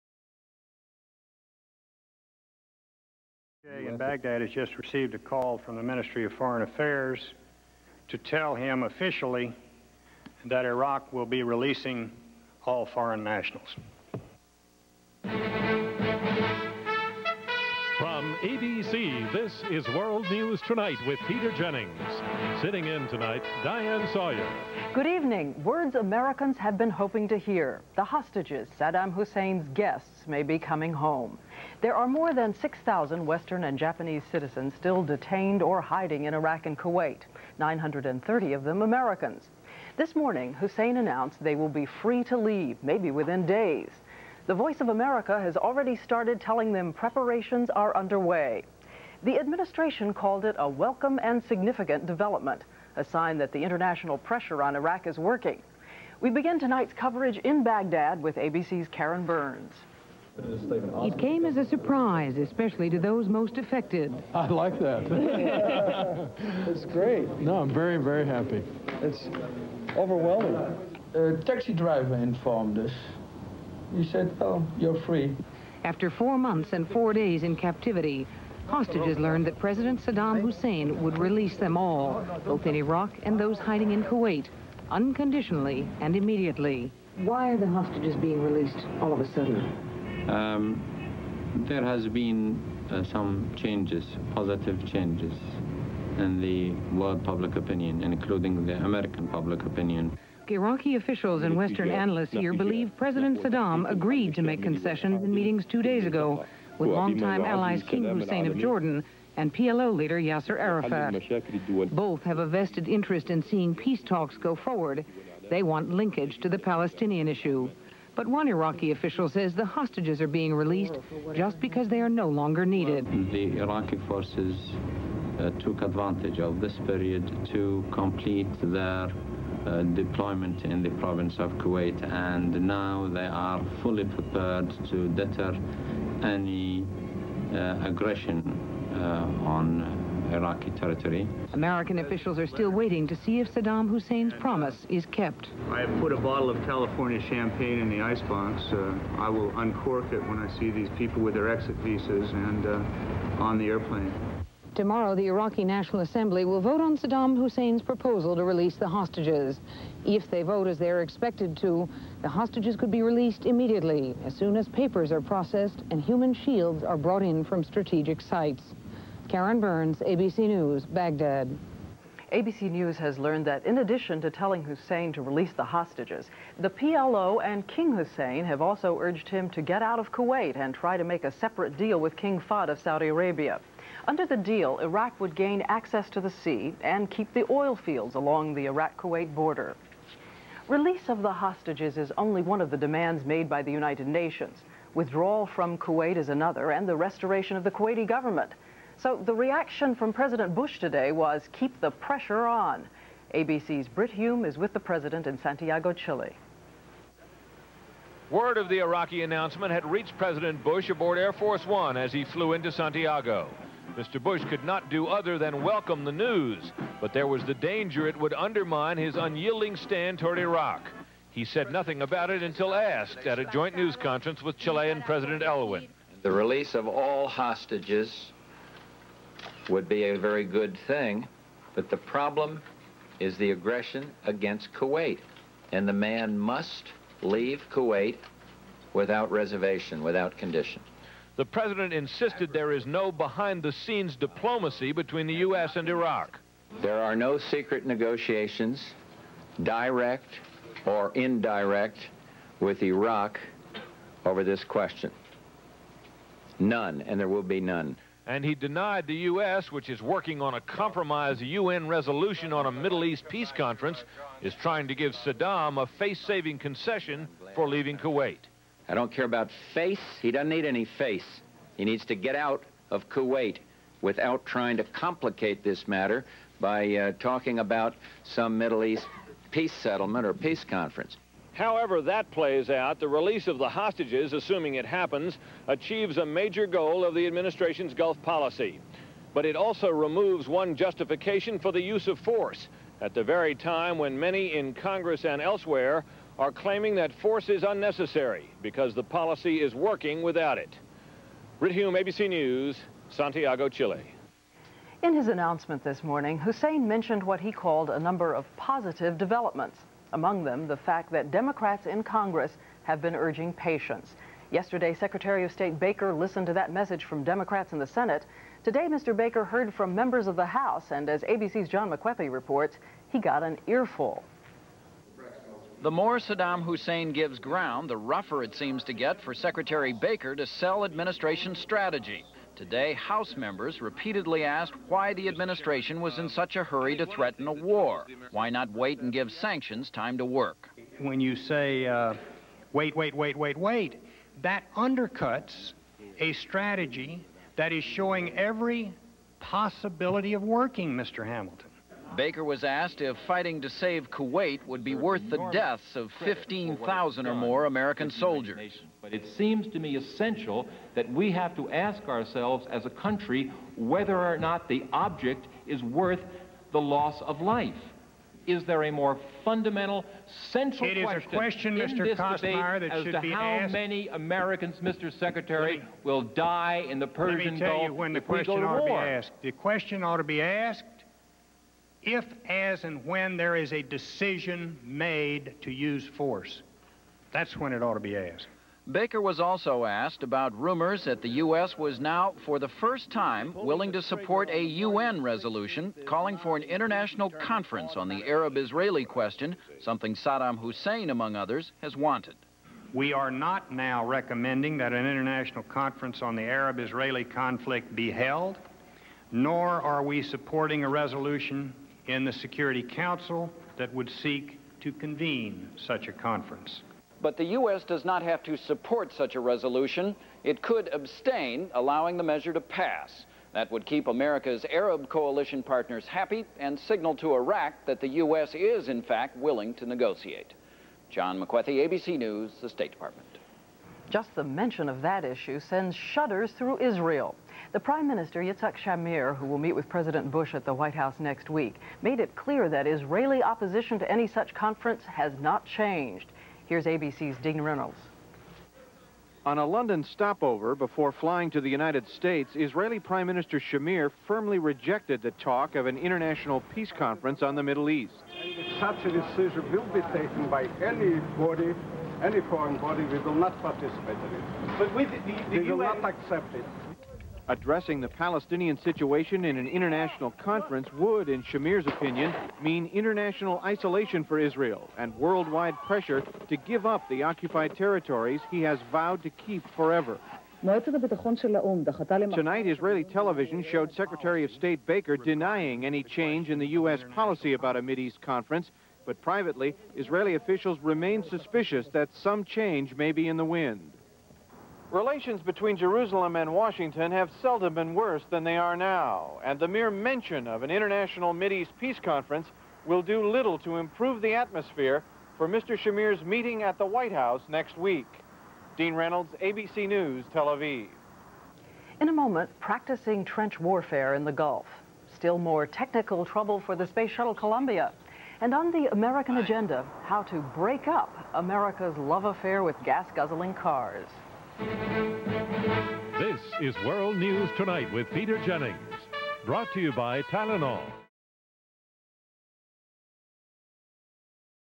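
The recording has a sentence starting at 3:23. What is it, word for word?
ABC's Brit Hume is with the president in Santiago, Chile.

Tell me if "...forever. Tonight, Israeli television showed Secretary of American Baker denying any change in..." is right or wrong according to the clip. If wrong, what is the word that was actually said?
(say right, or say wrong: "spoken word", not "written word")
wrong: "State", not "American".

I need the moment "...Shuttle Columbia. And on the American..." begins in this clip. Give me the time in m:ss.
8:37.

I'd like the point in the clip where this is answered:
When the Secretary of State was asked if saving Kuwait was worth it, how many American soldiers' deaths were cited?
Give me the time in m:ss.
5:56.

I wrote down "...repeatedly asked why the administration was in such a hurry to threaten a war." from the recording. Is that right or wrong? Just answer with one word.
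right.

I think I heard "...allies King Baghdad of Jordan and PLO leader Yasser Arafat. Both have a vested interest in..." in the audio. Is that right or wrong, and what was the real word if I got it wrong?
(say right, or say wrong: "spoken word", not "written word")
wrong: "Hussein", not "Baghdad".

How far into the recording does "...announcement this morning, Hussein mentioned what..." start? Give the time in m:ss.
5:05.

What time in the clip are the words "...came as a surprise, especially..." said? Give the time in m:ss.
1:01.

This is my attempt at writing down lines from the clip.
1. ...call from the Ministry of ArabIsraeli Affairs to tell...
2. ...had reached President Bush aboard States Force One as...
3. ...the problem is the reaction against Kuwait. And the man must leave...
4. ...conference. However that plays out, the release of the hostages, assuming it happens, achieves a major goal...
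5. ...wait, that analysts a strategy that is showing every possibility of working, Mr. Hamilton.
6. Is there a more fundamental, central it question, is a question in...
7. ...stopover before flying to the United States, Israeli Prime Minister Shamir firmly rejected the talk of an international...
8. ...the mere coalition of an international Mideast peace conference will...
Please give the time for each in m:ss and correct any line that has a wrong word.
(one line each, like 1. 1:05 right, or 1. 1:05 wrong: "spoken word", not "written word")
1. 0:05 wrong: "Foreign", not "ArabIsraeli"
2. 3:29 wrong: "Air", not "States"
3. 3:51 wrong: "aggression", not "reaction"
4. 4:40 right
5. 5:43 wrong: "undercuts", not "analysts"
6. 6:08 right
7. 7:30 right
8. 8:19 wrong: "mention", not "coalition".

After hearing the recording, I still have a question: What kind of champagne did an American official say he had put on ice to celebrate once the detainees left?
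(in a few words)
California champagne.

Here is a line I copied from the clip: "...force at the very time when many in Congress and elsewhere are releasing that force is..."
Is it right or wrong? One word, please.
wrong.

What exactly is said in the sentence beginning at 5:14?
Yesterday, Secretary of State Baker listened to that message from Democrats in the Senate.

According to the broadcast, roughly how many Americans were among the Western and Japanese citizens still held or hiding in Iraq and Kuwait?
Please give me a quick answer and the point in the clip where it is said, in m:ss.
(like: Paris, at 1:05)
930, at 0:37.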